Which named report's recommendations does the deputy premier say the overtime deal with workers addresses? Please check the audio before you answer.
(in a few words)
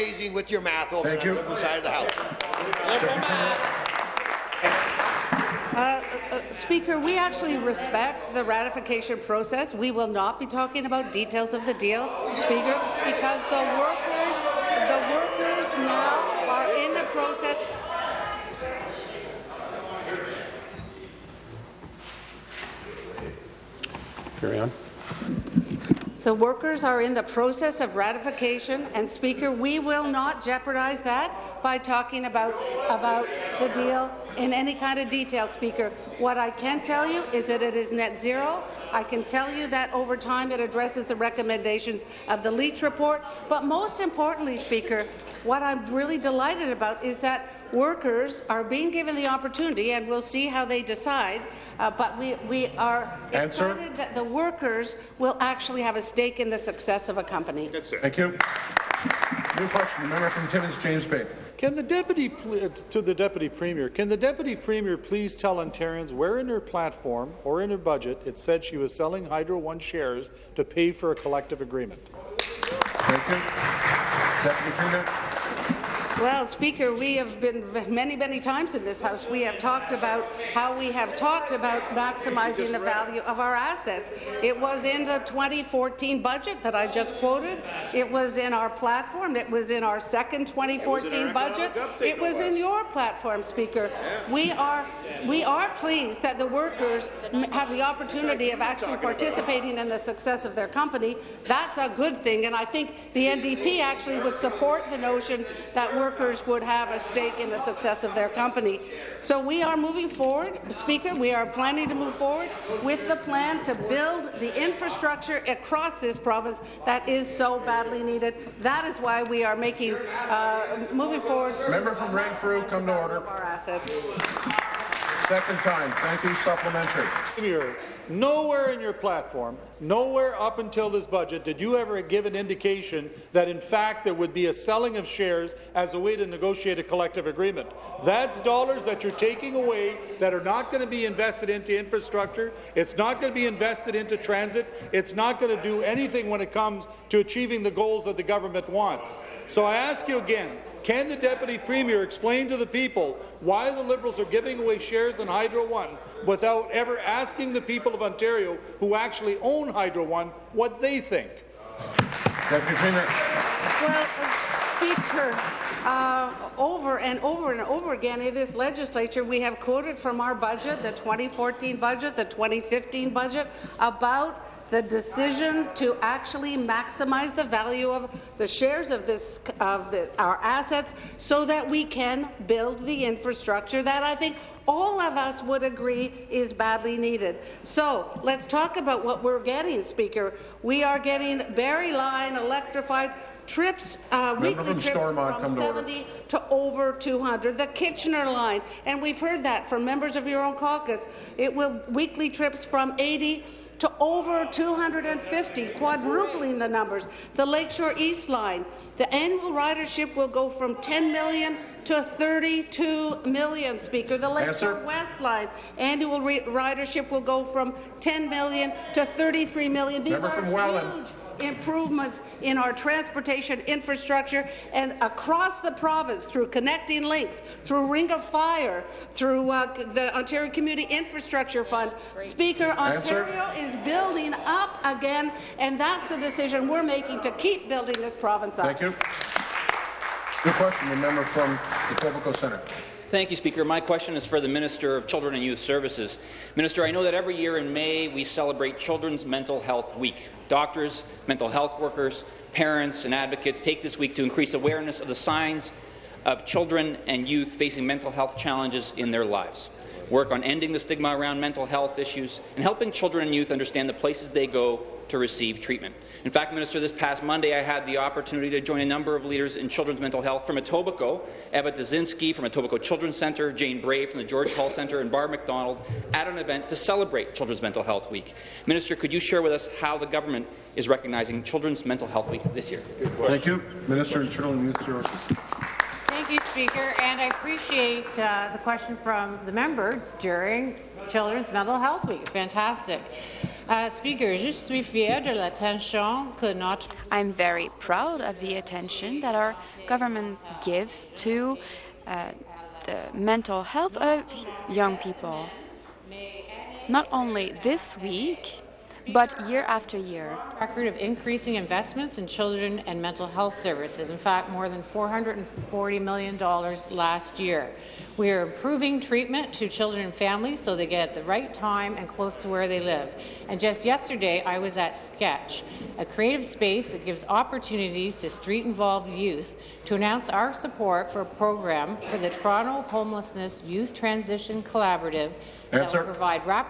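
Leech report.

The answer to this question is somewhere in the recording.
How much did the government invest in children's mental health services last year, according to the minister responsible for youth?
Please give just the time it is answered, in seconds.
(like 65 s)
314 s.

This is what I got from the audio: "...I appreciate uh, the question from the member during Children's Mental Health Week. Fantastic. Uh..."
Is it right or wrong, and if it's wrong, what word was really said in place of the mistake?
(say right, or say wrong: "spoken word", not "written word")
right.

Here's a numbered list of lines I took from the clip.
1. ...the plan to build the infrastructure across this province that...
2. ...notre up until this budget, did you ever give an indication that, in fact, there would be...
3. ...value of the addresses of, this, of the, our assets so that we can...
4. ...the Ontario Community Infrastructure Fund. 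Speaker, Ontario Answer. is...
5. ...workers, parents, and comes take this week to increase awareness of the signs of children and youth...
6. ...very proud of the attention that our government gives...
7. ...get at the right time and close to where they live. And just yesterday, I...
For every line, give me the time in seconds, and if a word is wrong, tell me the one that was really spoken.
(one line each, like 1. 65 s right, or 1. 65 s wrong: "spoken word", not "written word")
1. 113 s right
2. 129 s wrong: "nowhere", not "notre"
3. 177 s wrong: "shares", not "addresses"
4. 229 s right
5. 251 s wrong: "advocates", not "comes"
6. 297 s right
7. 320 s right.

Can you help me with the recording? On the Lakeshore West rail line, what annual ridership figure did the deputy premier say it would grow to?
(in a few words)
33 million.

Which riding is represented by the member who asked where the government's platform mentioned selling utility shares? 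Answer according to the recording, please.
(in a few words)
Timmins, James Bay.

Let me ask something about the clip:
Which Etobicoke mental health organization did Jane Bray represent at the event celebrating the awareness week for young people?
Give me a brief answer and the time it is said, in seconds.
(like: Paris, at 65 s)
George Hull Centre, at 274 s.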